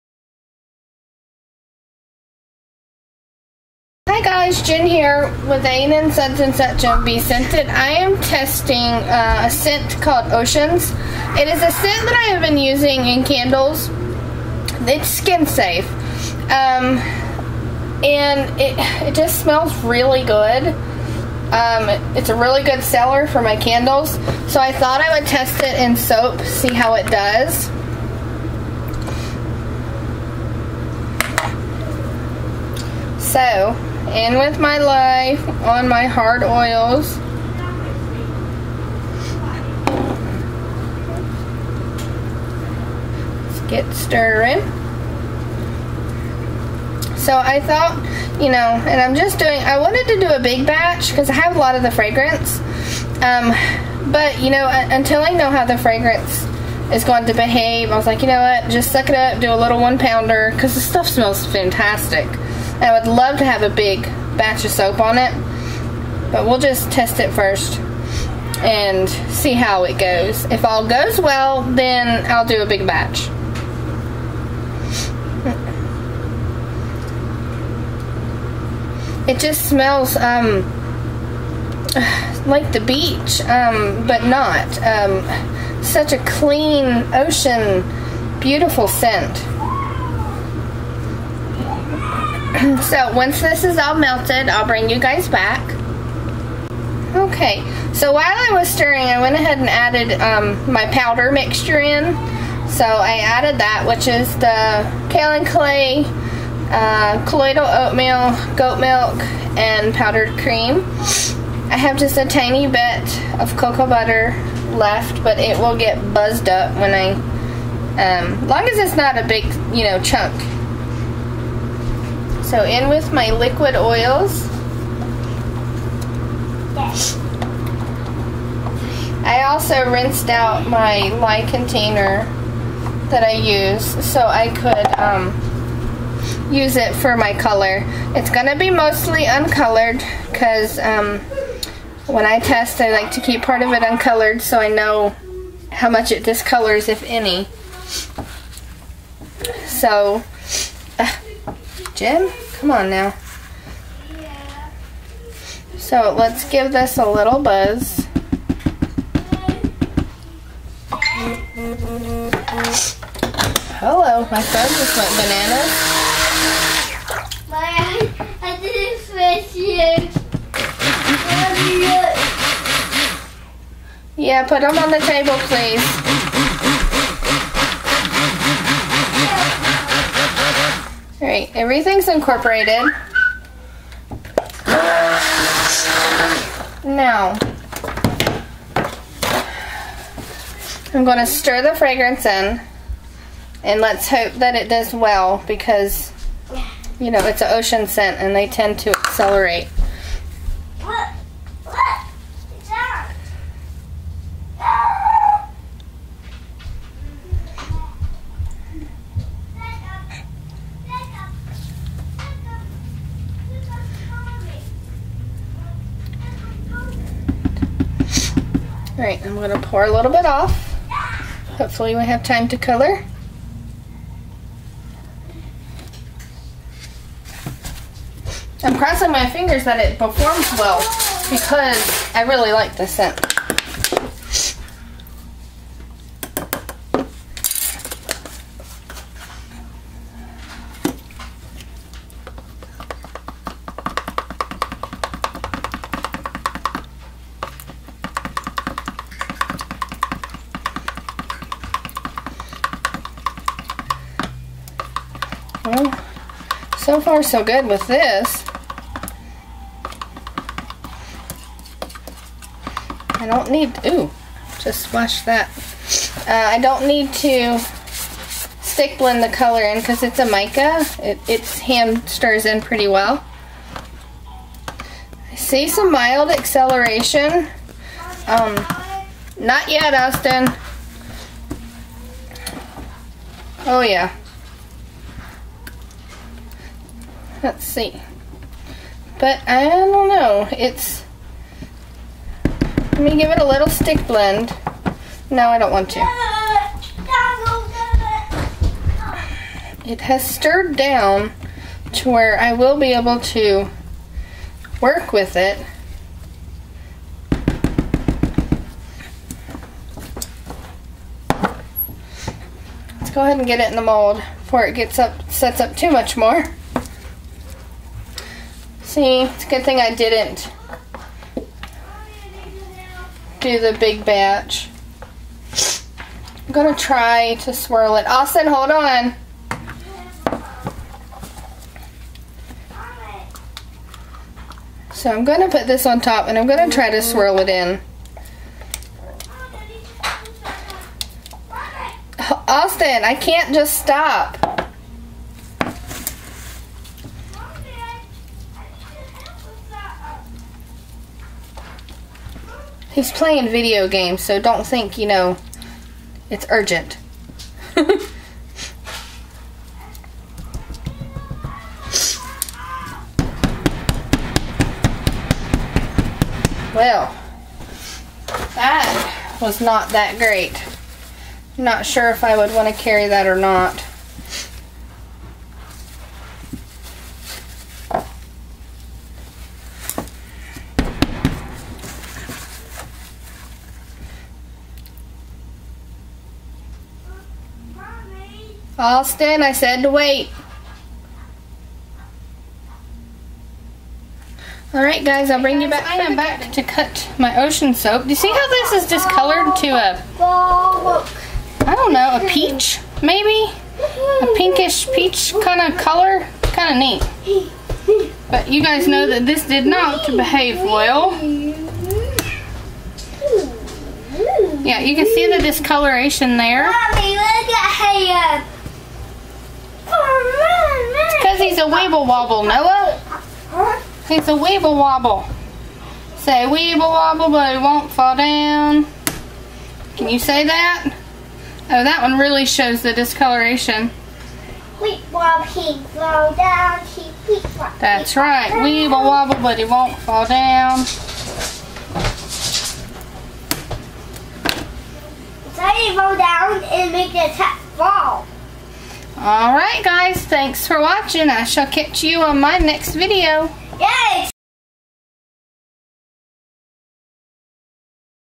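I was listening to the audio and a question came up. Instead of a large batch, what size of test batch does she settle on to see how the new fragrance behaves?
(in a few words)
one pounder.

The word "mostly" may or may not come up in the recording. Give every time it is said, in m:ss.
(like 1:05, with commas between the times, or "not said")
2:18.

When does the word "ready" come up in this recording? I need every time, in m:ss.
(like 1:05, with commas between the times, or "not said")
not said.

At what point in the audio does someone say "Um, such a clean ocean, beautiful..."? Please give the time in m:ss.
1:24.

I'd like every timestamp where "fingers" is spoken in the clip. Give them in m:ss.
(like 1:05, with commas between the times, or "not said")
3:49.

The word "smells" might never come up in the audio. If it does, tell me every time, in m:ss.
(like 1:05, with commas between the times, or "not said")
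0:19, 1:01, 1:19.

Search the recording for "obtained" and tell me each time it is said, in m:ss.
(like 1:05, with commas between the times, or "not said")
not said.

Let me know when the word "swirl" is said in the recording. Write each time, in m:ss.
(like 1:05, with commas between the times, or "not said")
5:27, 5:37.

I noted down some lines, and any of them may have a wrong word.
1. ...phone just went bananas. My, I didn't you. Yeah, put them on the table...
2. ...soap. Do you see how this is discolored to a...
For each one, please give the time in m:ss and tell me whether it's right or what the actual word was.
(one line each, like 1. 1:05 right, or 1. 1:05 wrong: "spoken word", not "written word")
1. 2:44 right
2. 6:37 right.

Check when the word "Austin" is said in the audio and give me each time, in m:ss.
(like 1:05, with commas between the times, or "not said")
4:39, 5:28, 5:42, 6:28.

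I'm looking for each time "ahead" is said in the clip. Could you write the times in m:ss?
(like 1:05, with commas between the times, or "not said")
1:39, 5:13.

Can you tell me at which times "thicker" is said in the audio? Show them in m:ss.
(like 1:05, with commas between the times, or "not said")
not said.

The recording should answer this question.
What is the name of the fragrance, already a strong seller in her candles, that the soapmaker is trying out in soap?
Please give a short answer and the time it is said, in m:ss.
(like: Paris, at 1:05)
Oceans, at 0:10.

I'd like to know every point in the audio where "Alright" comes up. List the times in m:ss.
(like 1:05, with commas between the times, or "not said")
3:39, 6:34, 7:29.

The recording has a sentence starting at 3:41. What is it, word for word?
Hopefully we have time to color.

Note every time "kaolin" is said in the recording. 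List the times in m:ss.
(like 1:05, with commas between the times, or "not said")
1:45.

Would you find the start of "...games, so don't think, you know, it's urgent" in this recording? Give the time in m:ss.
5:53.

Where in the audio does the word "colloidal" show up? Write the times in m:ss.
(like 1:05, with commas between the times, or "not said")
1:47.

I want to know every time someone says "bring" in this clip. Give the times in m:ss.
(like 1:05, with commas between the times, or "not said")
1:34, 6:35.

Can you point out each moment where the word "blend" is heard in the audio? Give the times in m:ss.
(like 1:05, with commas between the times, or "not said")
4:28, 4:54.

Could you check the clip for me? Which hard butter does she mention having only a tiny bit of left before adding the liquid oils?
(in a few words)
cocoa butter.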